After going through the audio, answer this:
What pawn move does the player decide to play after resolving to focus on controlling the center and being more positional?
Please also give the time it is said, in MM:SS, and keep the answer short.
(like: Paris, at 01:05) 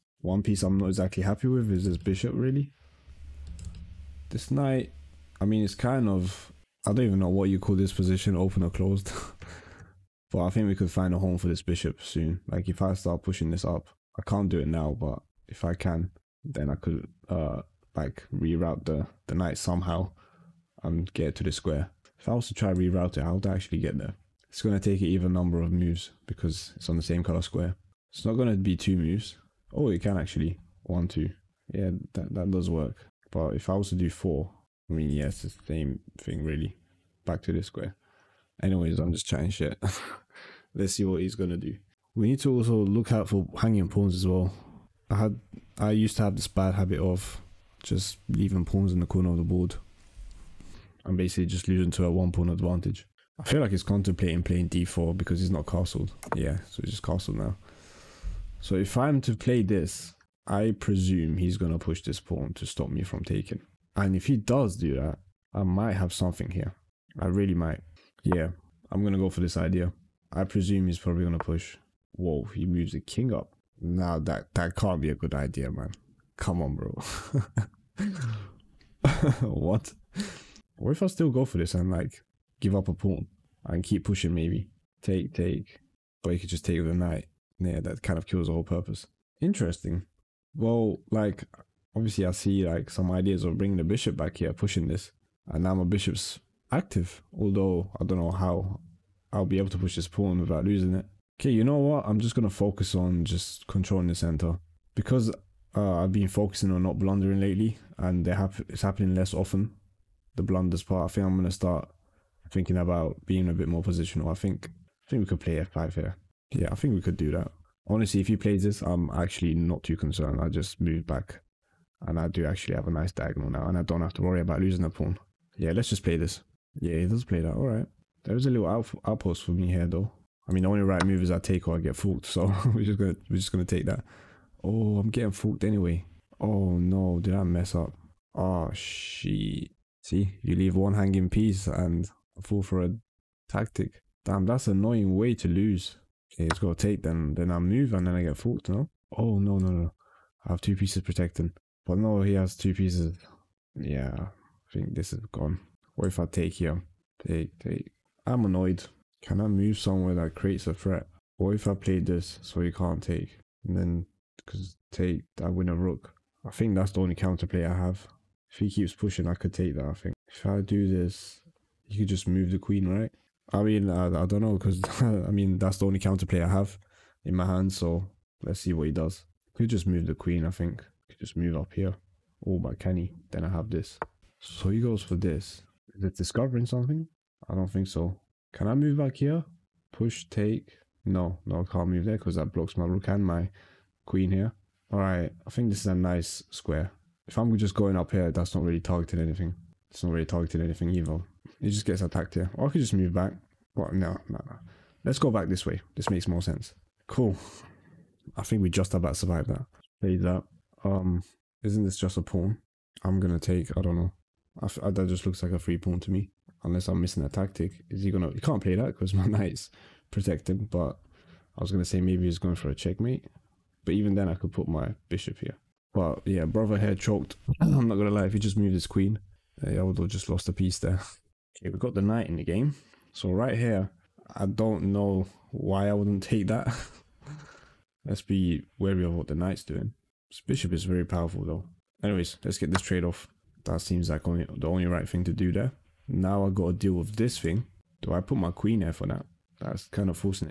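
f5, at 01:55.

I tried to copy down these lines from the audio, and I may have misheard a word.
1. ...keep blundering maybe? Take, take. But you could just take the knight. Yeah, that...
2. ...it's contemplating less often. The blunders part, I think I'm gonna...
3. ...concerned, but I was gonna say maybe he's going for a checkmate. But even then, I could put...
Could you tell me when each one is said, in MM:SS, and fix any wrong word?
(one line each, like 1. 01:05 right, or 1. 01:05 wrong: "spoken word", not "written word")
1. 01:23 wrong: "pushing", not "blundering"
2. 01:48 wrong: "happening", not "contemplating"
3. 03:40 wrong: "protected", not "concerned".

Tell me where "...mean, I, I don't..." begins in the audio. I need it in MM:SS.
02:53.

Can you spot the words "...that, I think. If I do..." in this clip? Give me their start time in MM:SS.
02:49.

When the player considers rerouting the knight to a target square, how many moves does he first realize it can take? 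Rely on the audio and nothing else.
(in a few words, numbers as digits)
2.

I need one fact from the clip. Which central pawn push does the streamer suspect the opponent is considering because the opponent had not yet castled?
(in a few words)
d4.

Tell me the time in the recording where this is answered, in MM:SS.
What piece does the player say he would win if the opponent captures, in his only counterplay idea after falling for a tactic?
02:45.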